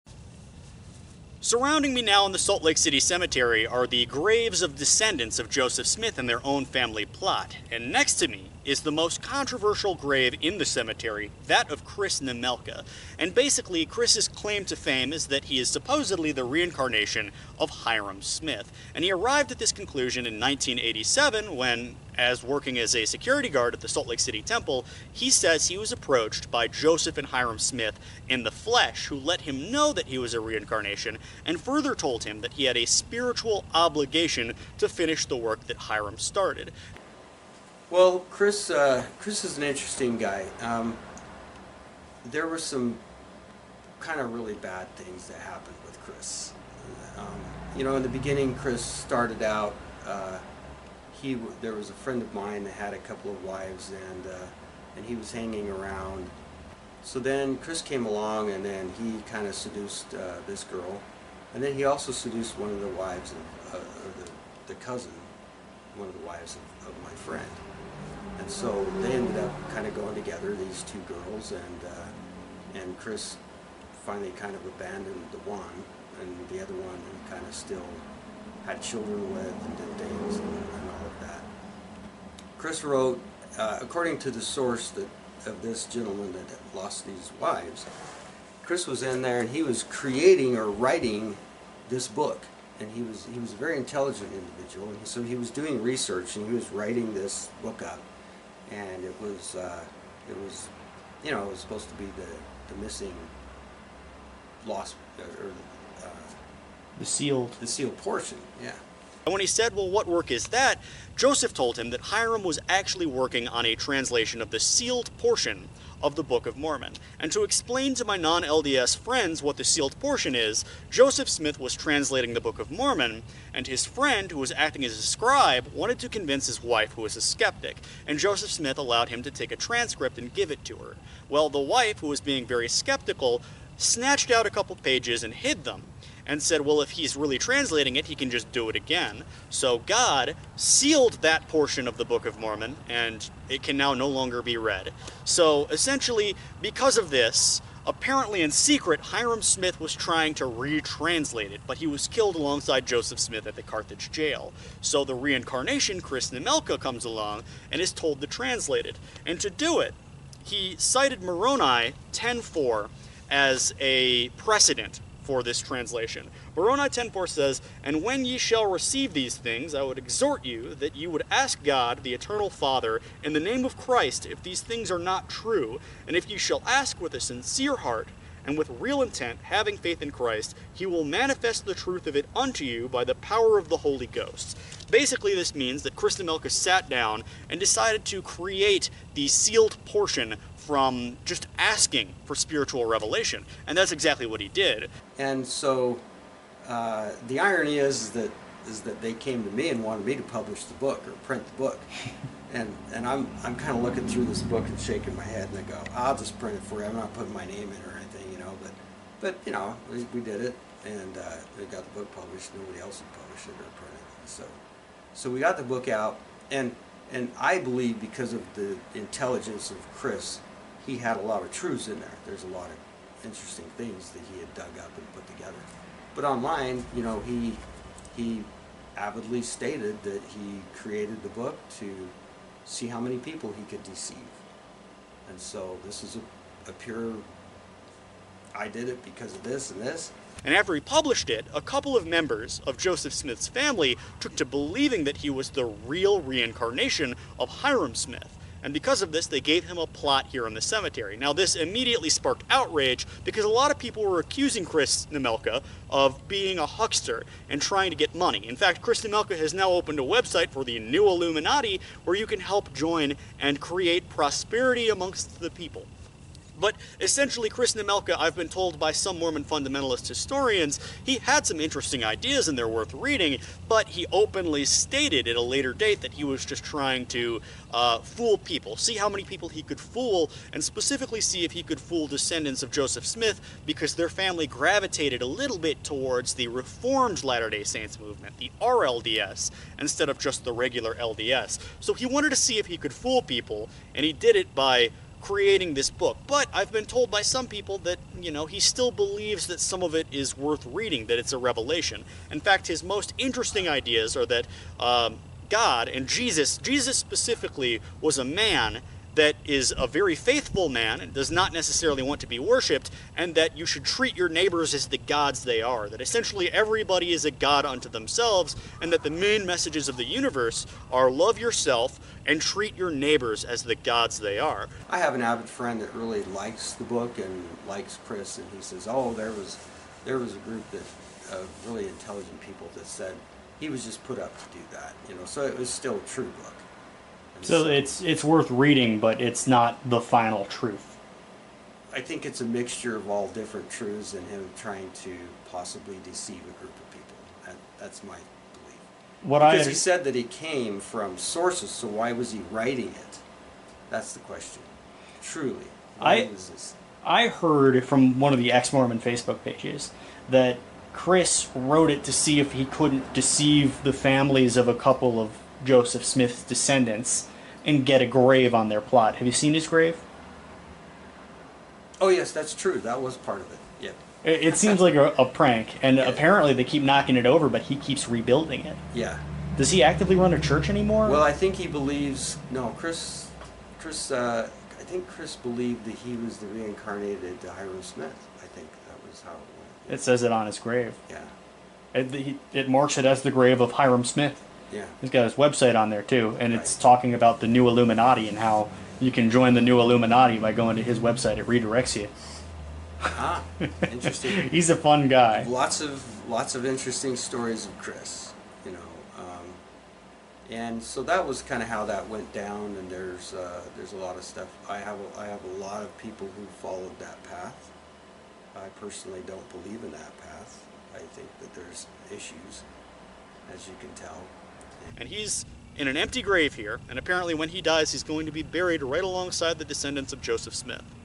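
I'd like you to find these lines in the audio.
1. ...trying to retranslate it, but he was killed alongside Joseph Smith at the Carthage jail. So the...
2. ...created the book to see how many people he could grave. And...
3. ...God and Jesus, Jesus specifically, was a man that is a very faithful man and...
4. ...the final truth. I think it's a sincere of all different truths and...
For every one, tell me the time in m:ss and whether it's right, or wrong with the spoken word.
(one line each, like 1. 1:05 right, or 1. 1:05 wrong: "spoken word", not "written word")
1. 2:29 right
2. 3:50 wrong: "deceive", not "grave"
3. 5:05 right
4. 5:39 wrong: "mixture", not "sincere".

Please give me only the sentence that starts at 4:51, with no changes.
So he wanted to see if he could fool people, and he did it by creating this book.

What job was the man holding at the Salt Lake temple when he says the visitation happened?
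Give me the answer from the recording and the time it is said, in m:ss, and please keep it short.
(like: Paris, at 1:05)
security guard, at 0:23.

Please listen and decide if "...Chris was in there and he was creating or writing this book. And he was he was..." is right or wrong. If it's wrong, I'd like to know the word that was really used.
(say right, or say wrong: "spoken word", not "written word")
right.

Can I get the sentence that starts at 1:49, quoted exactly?
And when he said, Well, what work is that?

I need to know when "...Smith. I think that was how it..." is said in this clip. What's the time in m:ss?
6:27.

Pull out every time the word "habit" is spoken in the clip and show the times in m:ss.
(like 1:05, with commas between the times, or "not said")
not said.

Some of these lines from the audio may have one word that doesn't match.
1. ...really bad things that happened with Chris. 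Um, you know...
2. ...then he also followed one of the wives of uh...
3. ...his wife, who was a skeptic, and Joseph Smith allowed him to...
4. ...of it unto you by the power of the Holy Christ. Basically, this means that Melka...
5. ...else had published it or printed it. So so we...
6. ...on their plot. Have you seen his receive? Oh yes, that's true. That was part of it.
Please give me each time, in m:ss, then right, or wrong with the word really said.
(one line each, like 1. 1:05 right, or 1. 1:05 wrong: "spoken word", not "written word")
1. 0:44 right
2. 1:01 wrong: "seduced", not "followed"
3. 2:06 right
4. 3:02 wrong: "Ghost", not "Christ"
5. 3:32 right
6. 6:08 wrong: "grave", not "receive".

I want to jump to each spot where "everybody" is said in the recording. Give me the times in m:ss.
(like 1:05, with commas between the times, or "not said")
5:16.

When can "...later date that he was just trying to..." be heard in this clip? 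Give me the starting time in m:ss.
4:35.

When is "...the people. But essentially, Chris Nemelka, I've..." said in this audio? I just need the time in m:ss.
4:25.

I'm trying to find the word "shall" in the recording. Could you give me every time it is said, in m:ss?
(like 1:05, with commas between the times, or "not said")
2:48, 2:56.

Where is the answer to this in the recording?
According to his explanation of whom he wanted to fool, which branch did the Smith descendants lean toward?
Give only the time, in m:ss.
4:46.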